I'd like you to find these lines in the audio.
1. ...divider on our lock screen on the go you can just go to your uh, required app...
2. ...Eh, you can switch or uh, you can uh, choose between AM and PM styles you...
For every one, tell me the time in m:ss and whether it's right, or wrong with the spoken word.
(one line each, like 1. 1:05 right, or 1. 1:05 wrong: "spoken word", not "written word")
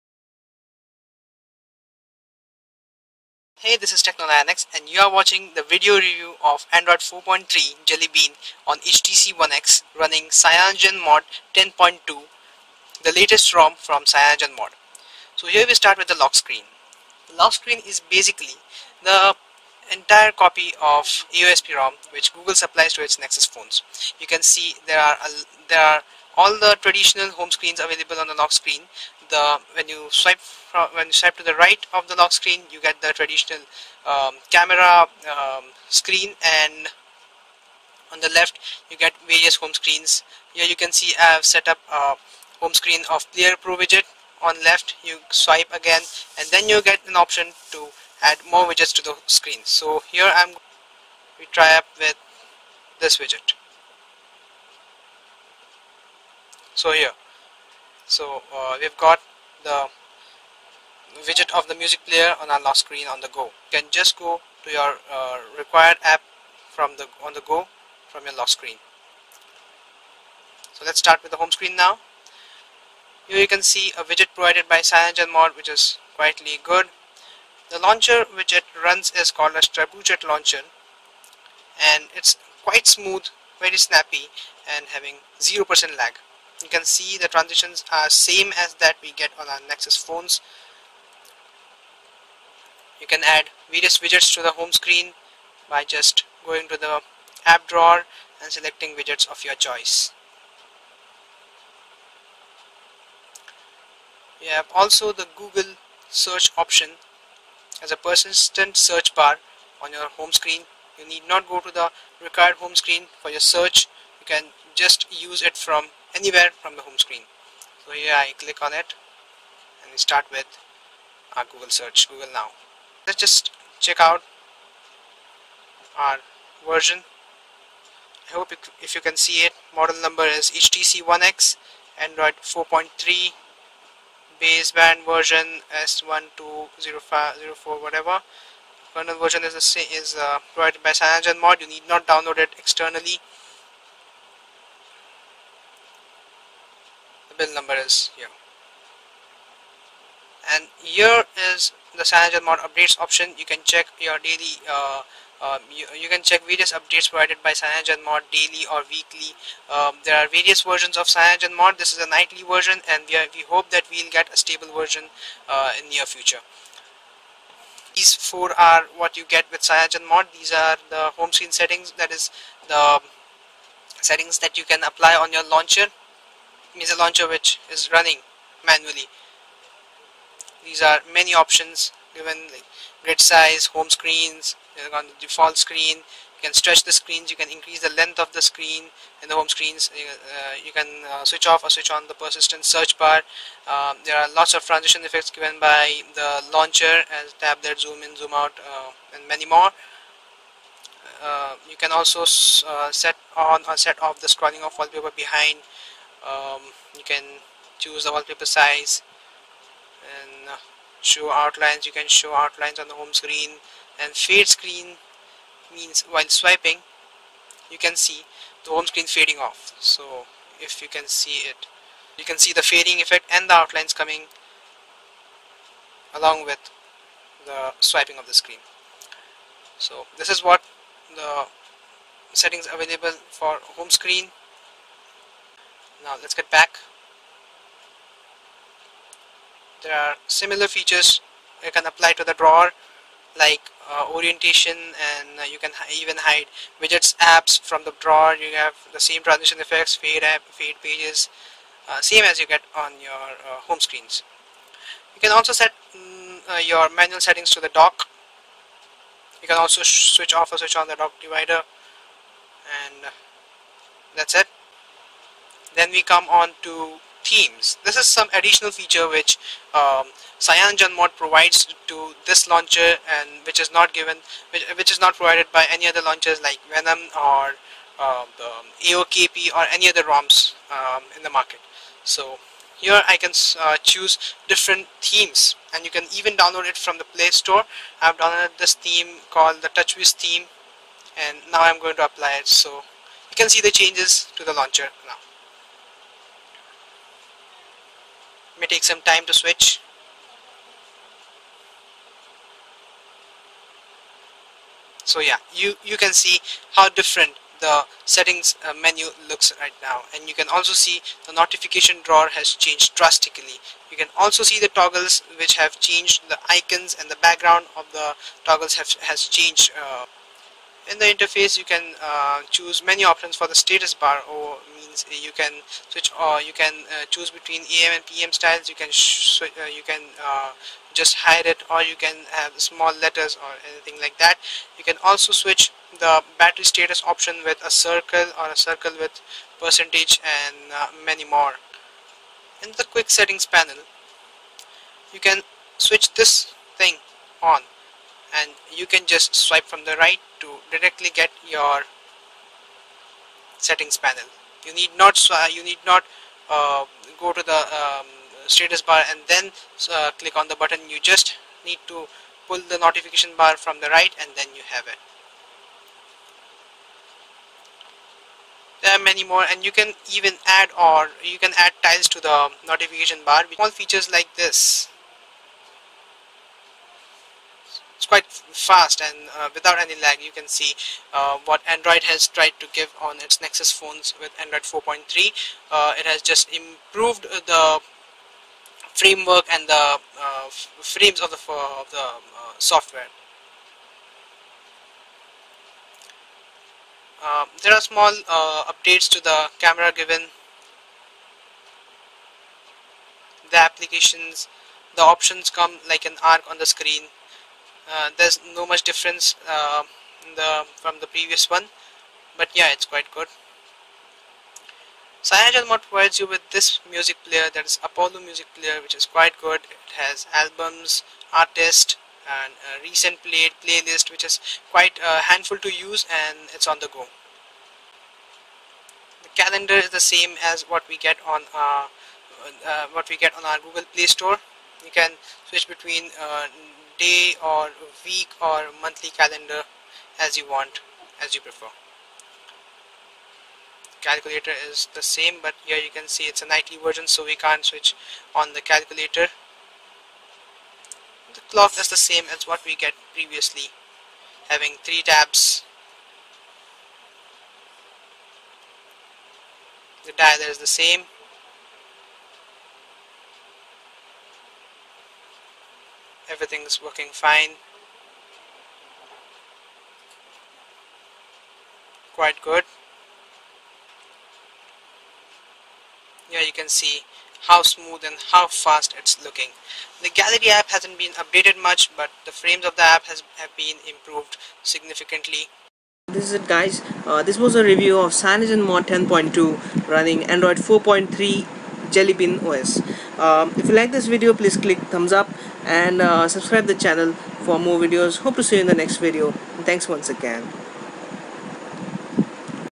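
1. 1:02 wrong: "player", not "divider"
2. 5:24 right.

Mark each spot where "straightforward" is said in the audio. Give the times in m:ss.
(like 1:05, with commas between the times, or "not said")
not said.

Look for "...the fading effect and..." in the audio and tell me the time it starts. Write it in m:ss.
3:42.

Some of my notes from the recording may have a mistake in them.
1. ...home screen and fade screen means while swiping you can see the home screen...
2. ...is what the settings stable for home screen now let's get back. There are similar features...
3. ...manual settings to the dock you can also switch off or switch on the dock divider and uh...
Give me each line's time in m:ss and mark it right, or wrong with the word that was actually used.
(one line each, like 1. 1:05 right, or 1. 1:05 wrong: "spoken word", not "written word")
1. 3:32 right
2. 3:50 wrong: "available", not "stable"
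3. 4:16 right.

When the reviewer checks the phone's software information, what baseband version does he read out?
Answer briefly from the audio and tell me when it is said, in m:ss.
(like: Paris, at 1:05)
S1204, at 2:15.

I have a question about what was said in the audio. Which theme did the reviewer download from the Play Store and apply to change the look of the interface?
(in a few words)
TouchWiz.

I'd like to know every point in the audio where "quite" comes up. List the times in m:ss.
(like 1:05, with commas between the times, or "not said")
1:22, 6:18, 6:52, 6:59, 7:04, 7:52.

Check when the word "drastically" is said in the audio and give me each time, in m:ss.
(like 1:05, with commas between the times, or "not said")
5:12.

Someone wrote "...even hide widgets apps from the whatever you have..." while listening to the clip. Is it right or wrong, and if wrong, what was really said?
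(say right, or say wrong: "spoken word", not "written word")
wrong: "drawer", not "whatever".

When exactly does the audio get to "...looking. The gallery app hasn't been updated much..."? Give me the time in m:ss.
7:59.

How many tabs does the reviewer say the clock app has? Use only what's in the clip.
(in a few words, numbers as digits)
3.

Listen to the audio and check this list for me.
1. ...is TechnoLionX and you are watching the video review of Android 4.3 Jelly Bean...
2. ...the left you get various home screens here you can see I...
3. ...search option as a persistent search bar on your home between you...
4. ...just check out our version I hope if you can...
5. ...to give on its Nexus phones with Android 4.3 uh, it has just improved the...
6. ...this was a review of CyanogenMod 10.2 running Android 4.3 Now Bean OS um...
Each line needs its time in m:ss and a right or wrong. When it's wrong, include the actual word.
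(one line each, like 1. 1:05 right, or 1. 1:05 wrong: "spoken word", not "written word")
1. 0:03 right
2. 0:38 right
3. 1:46 wrong: "screen", not "between"
4. 2:03 right
5. 6:22 right
6. 8:07 wrong: "Jelly", not "Now".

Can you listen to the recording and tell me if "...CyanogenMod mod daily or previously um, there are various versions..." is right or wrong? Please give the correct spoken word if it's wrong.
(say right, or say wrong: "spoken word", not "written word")
wrong: "weekly", not "previously".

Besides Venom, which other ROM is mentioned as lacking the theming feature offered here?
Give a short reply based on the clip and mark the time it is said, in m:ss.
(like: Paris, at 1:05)
AOKP, at 4:38.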